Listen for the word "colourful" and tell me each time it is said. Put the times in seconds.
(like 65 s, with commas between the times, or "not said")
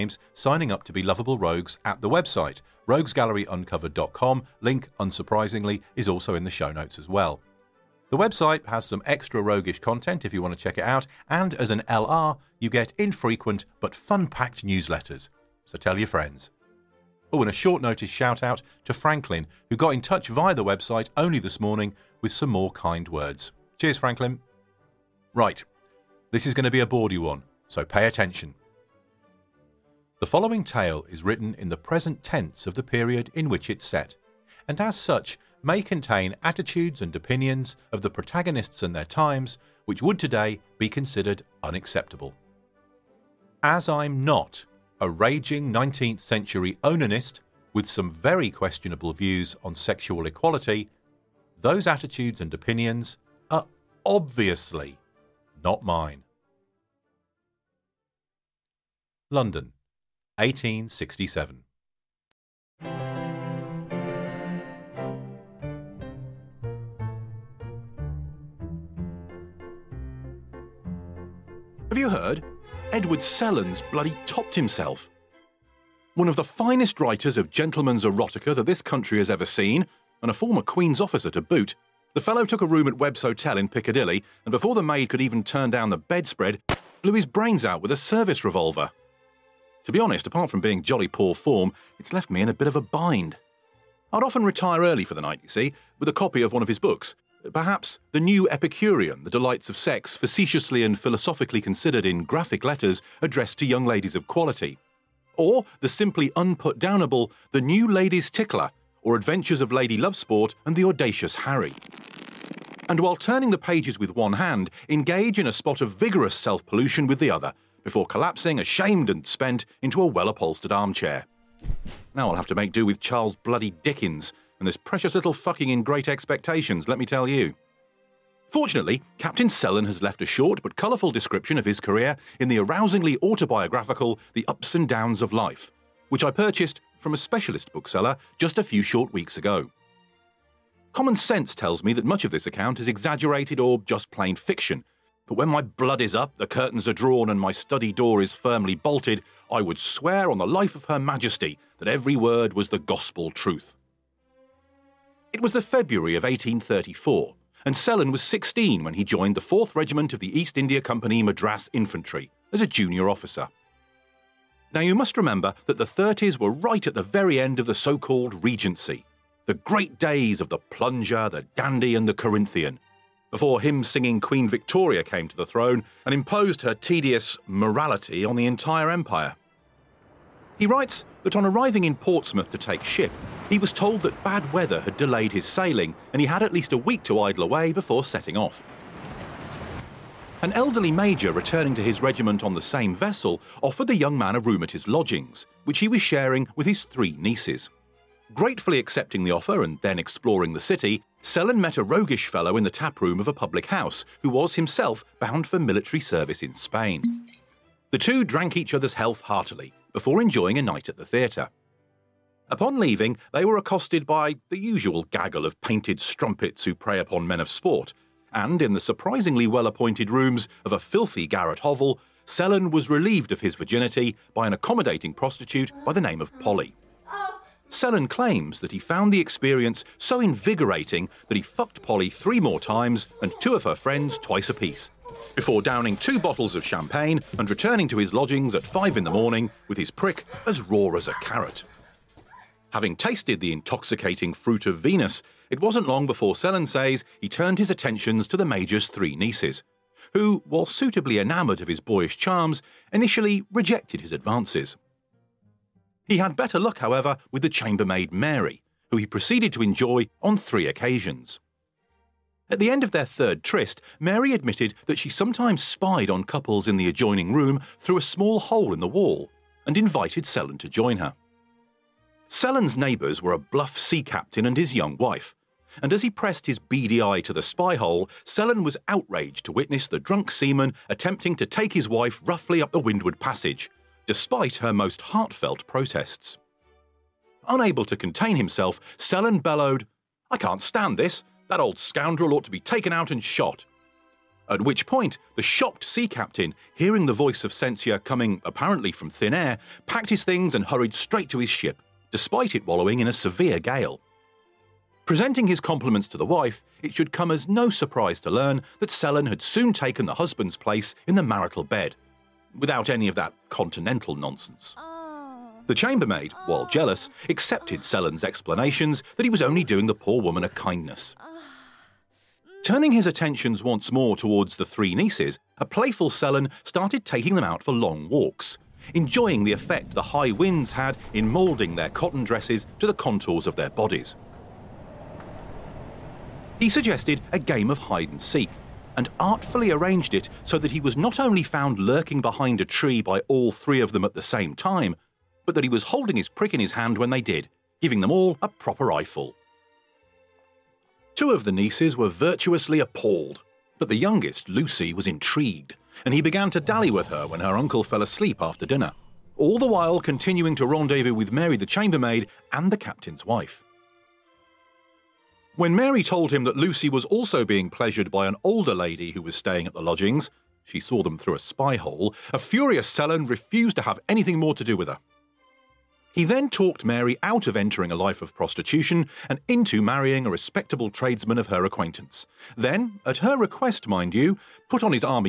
130 s.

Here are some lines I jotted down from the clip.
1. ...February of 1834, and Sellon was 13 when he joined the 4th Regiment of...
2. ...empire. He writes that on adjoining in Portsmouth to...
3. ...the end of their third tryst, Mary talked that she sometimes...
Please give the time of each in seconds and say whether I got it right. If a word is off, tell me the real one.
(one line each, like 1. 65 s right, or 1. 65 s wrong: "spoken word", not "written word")
1. 155 s wrong: "16", not "13"
2. 178 s wrong: "arriving", not "adjoining"
3. 262 s wrong: "admitted", not "talked".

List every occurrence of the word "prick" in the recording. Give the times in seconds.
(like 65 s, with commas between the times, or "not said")
239 s, 346 s.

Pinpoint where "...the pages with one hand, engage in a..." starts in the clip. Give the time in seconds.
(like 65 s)
113 s.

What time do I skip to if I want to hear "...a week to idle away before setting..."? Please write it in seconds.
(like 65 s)
186 s.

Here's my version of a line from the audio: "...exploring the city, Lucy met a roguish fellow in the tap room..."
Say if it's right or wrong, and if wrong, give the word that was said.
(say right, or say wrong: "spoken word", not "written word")
wrong: "Sellon", not "Lucy".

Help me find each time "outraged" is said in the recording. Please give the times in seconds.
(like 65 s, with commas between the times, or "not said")
278 s.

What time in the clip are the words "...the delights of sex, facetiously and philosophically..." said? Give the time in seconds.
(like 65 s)
99 s.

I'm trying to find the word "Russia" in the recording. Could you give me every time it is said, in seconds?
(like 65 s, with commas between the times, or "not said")
not said.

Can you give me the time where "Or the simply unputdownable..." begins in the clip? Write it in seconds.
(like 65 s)
105 s.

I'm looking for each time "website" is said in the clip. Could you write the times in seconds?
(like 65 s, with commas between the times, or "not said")
2 s, 8 s, 20 s.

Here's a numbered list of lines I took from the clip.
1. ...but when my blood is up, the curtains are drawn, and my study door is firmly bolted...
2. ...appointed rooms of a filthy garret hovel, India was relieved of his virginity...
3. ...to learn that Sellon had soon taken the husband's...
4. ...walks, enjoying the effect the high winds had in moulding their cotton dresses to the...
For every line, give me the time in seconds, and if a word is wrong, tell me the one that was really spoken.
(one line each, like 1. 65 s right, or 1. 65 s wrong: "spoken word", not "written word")
1. 145 s right
2. 219 s wrong: "Sellon", not "India"
3. 308 s right
4. 328 s right.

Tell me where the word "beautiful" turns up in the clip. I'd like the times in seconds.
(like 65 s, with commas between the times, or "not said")
not said.